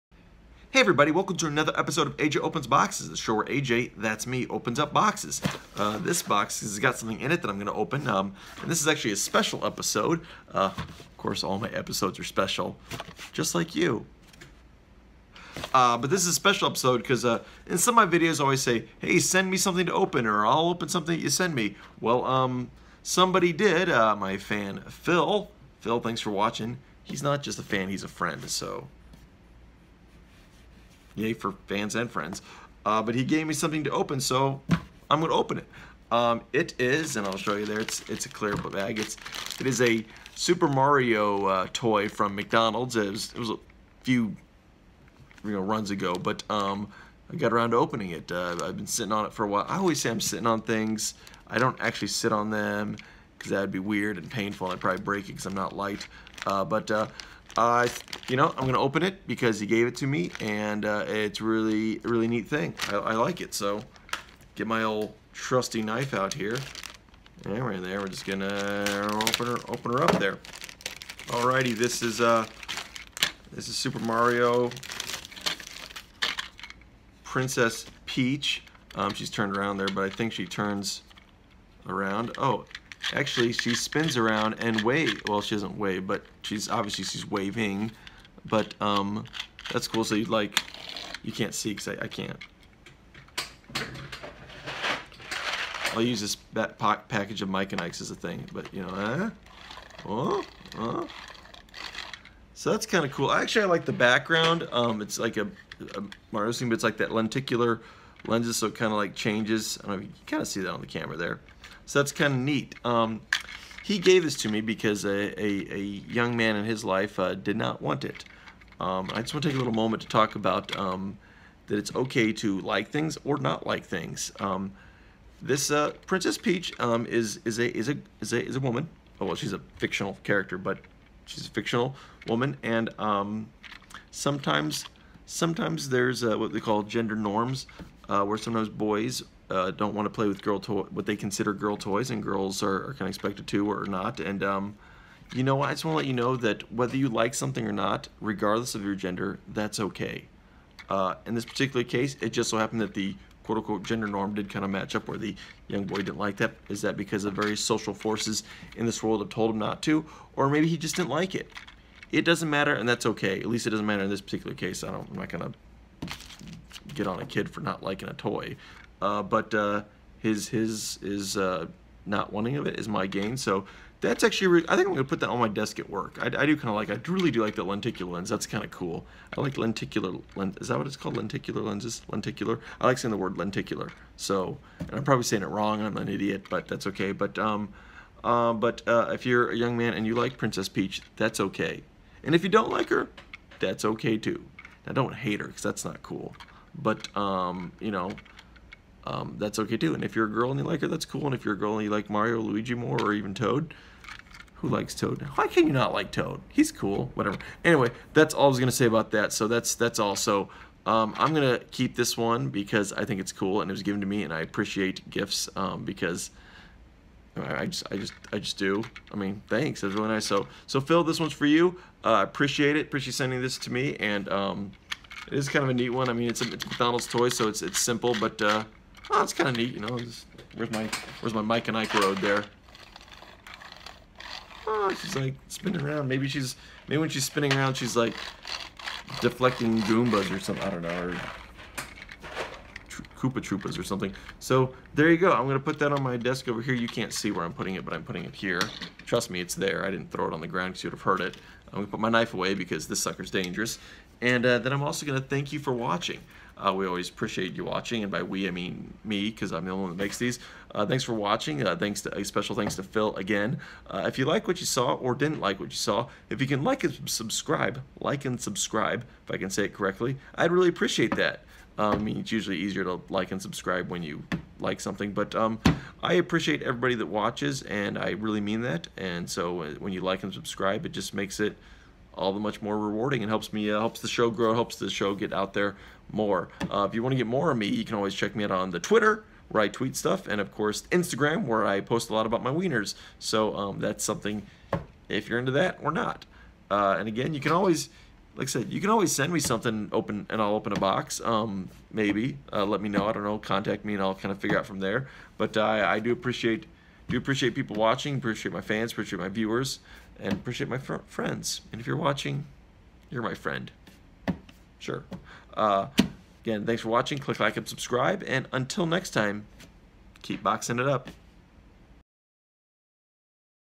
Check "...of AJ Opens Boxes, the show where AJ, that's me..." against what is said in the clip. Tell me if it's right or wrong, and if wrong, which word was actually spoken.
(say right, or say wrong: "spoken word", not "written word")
right.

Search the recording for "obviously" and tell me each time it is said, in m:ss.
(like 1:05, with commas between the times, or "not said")
1:26.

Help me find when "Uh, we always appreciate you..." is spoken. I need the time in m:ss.
4:16.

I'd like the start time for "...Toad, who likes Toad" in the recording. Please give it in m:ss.
3:23.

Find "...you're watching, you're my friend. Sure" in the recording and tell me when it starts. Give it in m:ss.
5:11.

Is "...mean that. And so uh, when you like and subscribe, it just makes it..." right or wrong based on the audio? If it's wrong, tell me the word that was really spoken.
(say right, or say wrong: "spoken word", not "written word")
right.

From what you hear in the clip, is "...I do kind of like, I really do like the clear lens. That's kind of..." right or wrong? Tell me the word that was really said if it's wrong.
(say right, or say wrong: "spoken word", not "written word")
wrong: "lenticular", not "clear".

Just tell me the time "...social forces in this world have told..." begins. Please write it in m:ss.
2:37.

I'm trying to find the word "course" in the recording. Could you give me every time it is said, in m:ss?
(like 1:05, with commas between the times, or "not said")
0:11, 4:50.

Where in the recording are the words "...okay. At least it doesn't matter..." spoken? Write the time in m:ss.
2:43.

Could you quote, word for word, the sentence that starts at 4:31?
Um, I mean, it's usually easier to like and subscribe when you like something.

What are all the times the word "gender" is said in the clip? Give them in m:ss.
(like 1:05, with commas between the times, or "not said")
2:16, 2:28, 2:33.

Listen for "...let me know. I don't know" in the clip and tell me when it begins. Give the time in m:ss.
5:02.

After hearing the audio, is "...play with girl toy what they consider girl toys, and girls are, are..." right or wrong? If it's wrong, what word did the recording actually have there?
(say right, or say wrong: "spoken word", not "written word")
right.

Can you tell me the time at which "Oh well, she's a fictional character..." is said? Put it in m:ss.
2:09.